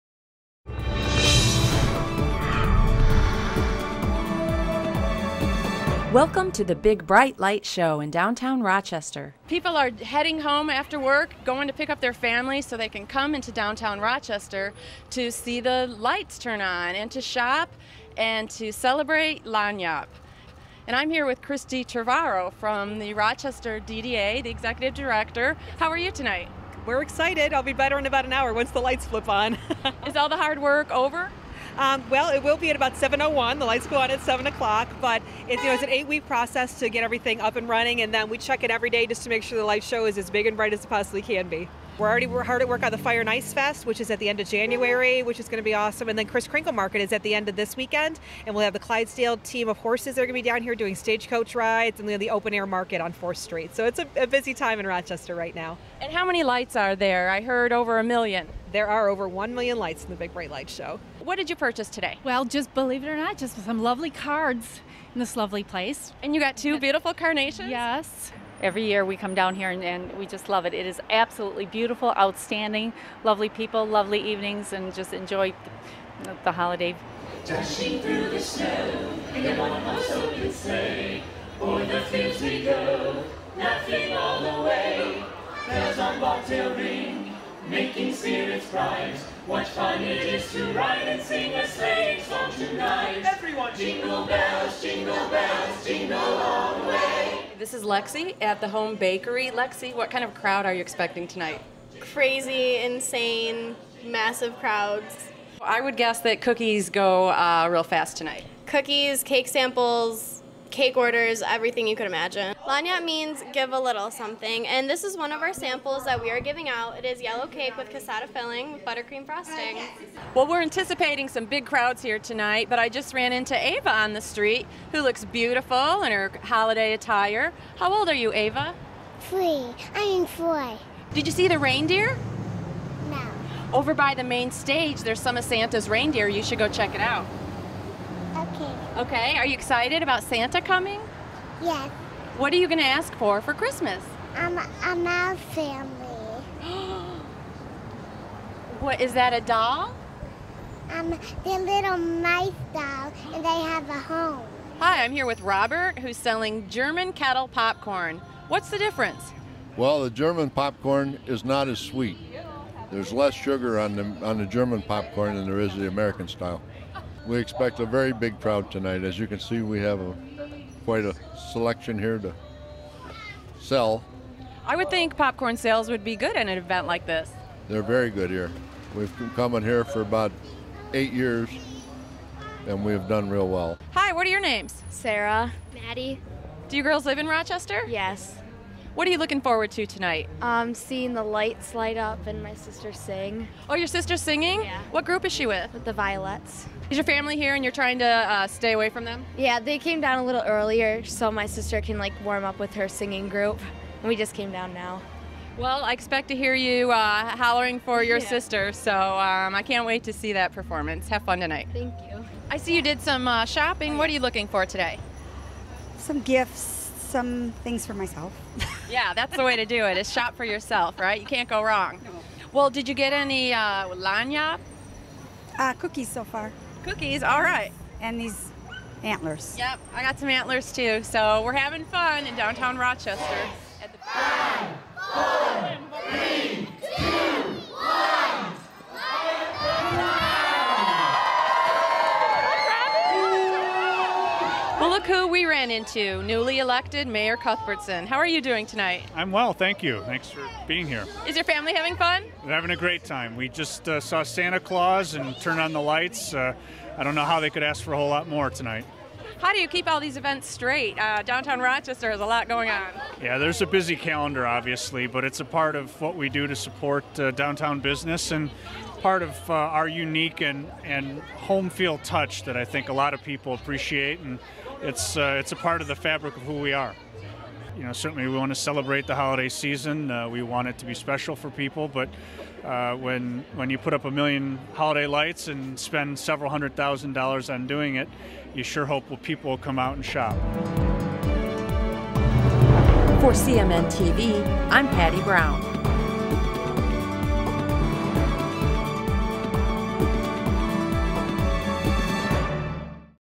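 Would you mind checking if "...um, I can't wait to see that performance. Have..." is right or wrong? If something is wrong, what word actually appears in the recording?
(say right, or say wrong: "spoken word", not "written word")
right.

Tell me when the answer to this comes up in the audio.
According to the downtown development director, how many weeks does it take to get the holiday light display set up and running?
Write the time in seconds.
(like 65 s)
35 s.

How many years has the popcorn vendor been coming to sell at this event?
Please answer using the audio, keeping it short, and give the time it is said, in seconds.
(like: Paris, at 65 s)
8, at 180 s.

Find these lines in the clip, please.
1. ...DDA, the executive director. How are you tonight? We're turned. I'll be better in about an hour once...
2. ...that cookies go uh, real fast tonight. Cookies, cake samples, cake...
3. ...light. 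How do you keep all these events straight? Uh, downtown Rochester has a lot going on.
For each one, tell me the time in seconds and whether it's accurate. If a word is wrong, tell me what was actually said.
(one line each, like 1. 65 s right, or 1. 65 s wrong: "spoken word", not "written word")
1. 23 s wrong: "excited", not "turned"
2. 106 s right
3. 258 s wrong: "tonight", not "light".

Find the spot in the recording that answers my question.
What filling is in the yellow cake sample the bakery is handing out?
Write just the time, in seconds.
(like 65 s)
117 s.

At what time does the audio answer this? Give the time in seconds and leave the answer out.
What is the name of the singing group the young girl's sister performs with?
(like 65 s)
195 s.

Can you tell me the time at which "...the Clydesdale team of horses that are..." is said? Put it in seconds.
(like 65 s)
48 s.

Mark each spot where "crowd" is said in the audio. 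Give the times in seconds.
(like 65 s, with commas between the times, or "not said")
100 s, 104 s, 121 s, 168 s.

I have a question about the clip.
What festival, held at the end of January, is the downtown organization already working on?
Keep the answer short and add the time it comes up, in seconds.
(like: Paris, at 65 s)
Fire and Ice Fest, at 42 s.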